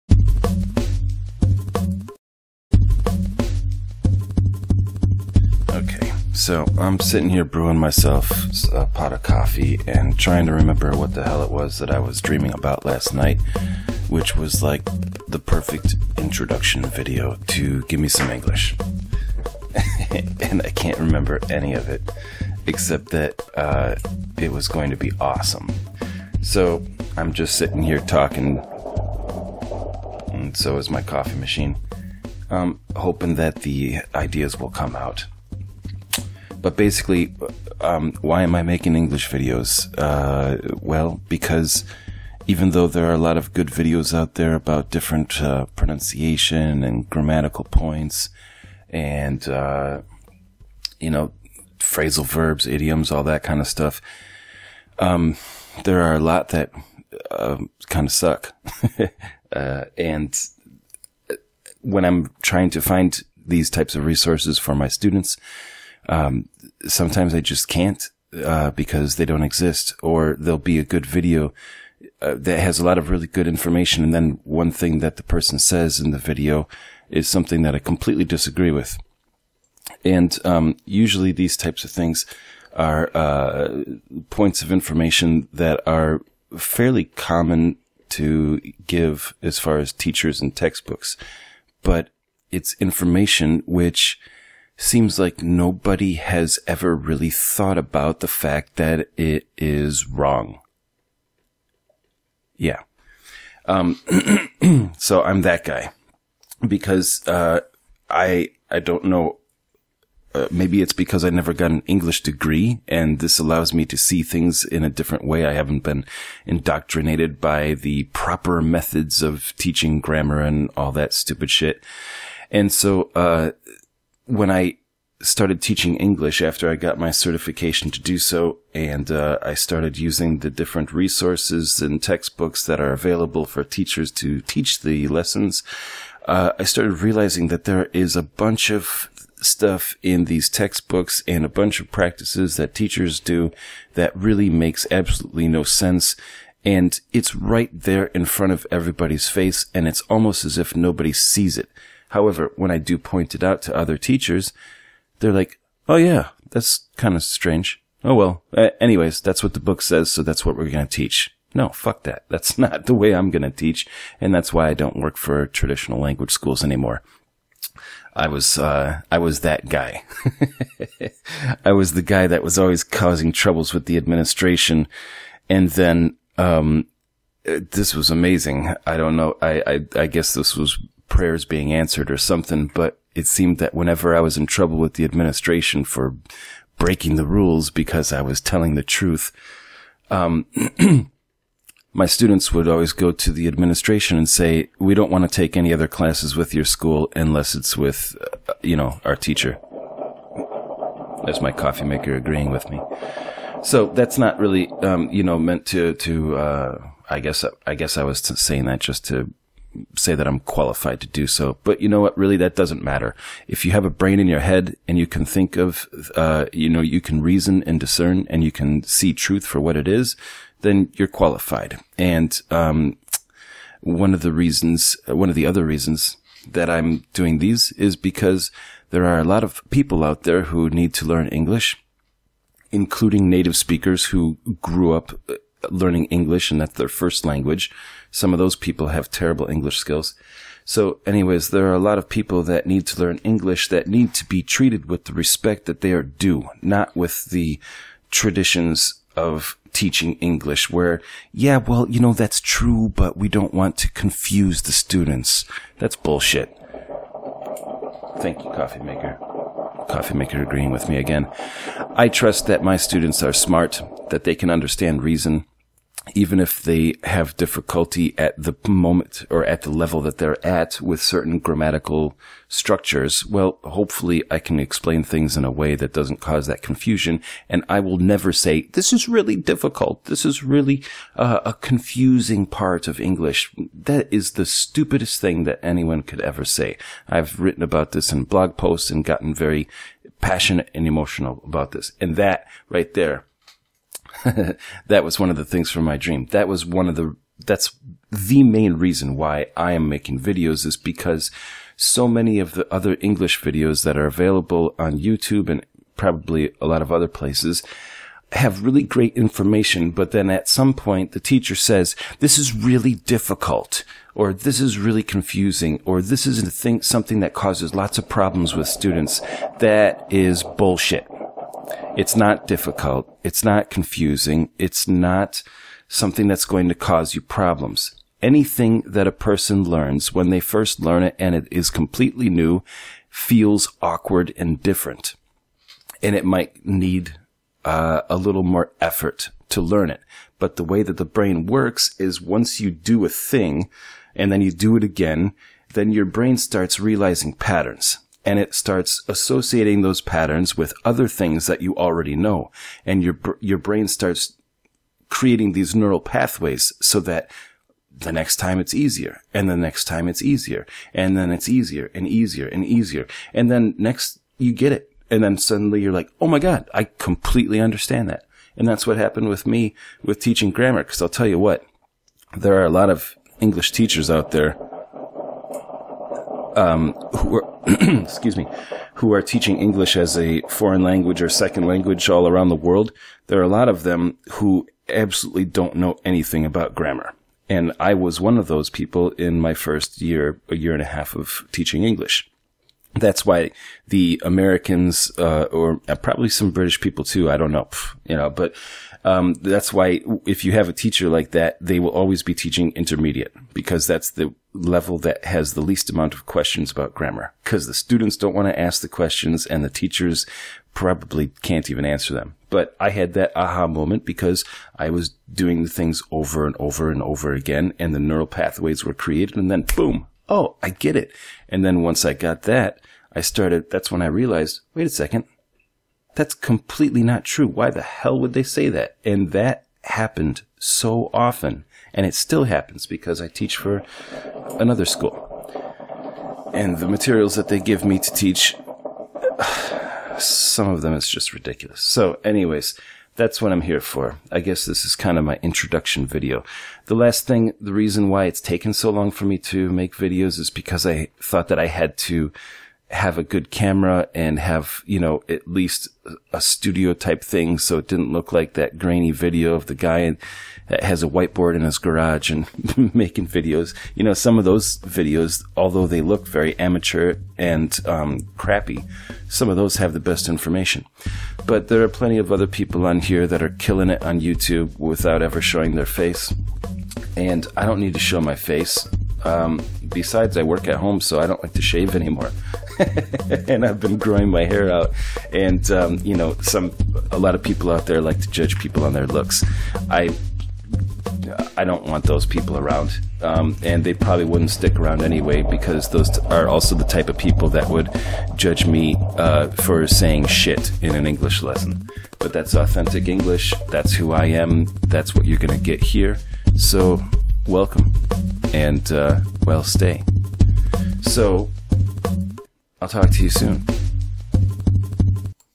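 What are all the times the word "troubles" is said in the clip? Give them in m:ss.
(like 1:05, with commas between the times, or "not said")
2:53, 3:04.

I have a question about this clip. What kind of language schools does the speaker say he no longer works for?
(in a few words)
traditional language schools.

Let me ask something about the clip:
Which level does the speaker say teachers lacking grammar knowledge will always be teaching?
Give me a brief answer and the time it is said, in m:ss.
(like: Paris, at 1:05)
intermediate, at 6:42.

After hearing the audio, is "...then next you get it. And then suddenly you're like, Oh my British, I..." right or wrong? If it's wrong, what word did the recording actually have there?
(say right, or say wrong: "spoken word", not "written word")
wrong: "God", not "British".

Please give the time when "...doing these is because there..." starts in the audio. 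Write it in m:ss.
3:47.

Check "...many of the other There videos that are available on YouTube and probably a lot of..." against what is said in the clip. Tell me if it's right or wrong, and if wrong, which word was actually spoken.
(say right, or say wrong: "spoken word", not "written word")
wrong: "English", not "There".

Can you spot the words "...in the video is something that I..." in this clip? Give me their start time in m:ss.
1:15.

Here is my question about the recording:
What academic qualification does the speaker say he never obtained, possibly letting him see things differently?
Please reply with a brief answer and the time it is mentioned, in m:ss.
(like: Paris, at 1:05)
English degree, at 1:51.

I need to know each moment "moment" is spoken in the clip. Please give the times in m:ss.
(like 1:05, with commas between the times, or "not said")
4:28, 6:53.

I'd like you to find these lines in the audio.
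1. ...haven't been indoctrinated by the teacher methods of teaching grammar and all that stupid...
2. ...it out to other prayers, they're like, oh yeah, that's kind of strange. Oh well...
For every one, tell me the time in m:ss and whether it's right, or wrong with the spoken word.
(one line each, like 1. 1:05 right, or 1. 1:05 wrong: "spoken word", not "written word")
1. 1:55 wrong: "proper", not "teacher"
2. 2:33 wrong: "teachers", not "prayers".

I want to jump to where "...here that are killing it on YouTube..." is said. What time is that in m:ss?
7:52.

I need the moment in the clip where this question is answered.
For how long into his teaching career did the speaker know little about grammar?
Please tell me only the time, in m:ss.
6:30.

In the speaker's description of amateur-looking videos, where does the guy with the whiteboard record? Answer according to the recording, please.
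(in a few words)
his garage.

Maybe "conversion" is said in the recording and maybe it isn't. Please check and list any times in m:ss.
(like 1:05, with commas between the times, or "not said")
not said.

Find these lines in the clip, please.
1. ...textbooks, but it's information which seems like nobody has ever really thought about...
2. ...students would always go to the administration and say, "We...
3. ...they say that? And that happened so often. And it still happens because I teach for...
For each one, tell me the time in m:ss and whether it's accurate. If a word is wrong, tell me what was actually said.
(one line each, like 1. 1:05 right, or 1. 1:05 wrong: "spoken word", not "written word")
1. 1:30 right
2. 3:12 right
3. 7:08 right.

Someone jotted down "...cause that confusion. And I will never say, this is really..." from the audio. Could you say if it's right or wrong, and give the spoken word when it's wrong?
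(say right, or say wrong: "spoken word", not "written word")
right.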